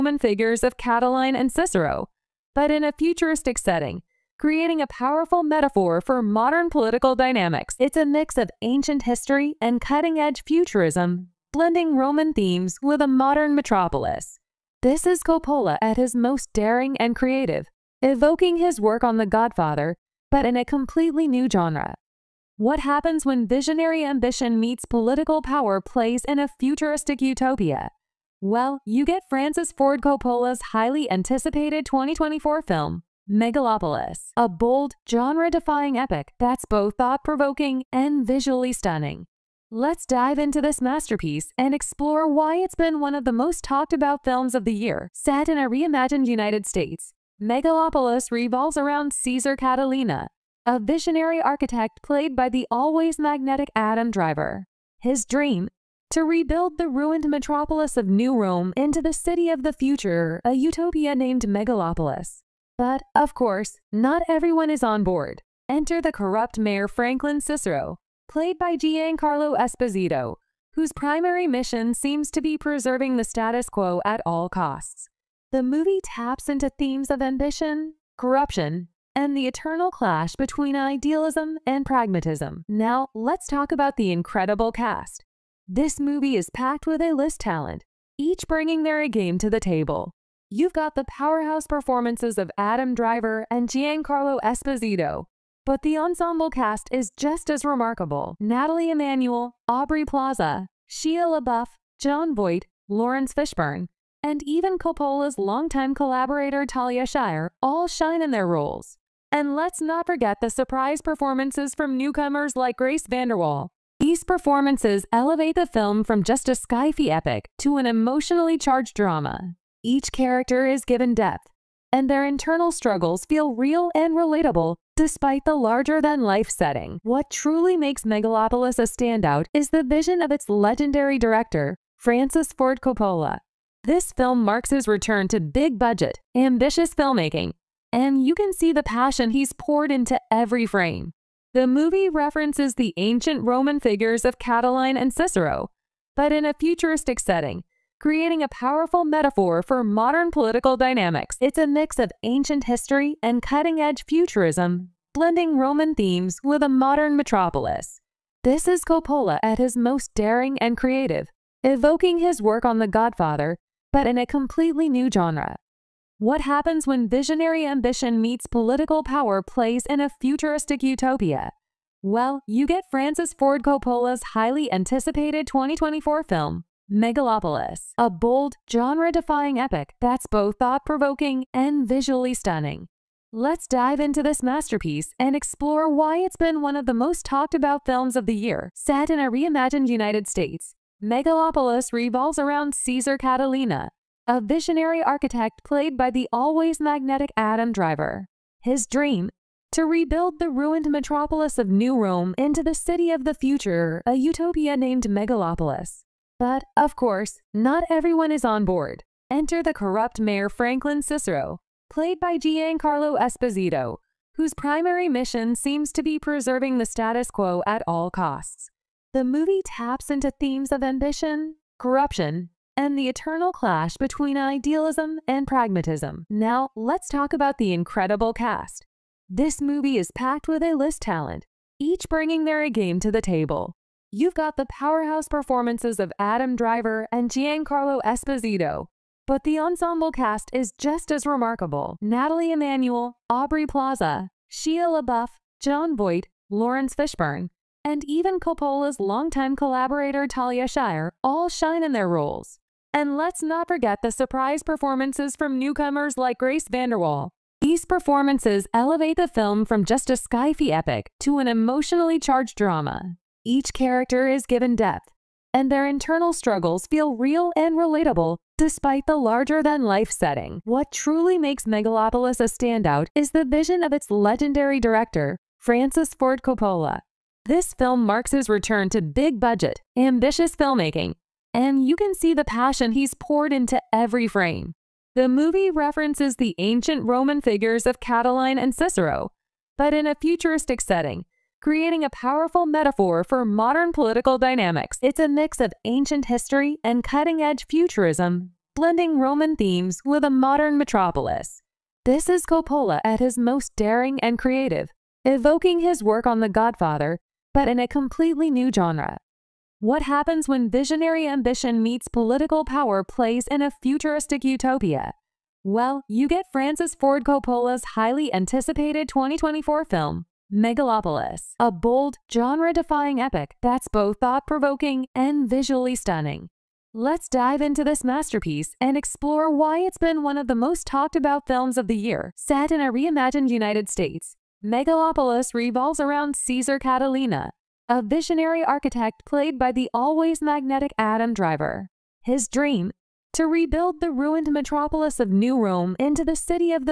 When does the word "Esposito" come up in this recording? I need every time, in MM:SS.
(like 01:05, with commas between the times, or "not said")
01:09, 01:34, 03:33, 03:58.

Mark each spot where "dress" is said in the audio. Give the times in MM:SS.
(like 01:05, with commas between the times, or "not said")
not said.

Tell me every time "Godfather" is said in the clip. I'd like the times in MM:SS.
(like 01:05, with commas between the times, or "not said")
00:19, 02:42, 05:06.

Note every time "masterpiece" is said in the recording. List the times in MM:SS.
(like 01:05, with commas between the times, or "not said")
00:40, 03:04, 05:28.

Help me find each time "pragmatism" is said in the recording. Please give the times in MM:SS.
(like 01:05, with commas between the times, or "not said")
01:21, 03:45.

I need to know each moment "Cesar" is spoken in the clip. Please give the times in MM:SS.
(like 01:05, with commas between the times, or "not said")
00:49, 03:12, 05:36.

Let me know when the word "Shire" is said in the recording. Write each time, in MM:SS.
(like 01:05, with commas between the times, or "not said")
01:47, 04:10.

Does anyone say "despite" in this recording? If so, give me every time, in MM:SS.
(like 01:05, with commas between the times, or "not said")
02:04, 04:28.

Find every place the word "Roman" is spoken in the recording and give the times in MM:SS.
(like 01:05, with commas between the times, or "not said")
00:11, 02:23, 02:35, 04:47, 04:59.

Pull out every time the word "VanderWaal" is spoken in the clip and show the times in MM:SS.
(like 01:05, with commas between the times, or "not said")
01:53, 04:16.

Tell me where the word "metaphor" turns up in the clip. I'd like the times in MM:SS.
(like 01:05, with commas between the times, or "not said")
00:05, 02:29, 04:52.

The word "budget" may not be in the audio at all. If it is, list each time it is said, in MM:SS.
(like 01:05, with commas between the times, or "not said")
02:15, 04:39.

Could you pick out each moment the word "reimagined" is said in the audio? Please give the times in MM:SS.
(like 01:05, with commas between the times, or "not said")
00:45, 03:09, 05:32.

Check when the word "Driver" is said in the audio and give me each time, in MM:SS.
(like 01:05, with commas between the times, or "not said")
00:54, 01:32, 03:17, 03:56, 05:41.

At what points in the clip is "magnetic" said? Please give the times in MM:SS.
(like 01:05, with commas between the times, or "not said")
00:53, 03:16, 05:40.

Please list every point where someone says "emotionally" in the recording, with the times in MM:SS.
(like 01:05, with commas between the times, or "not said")
01:57, 04:21.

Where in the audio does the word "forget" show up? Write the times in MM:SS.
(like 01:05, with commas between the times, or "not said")
01:50, 04:13.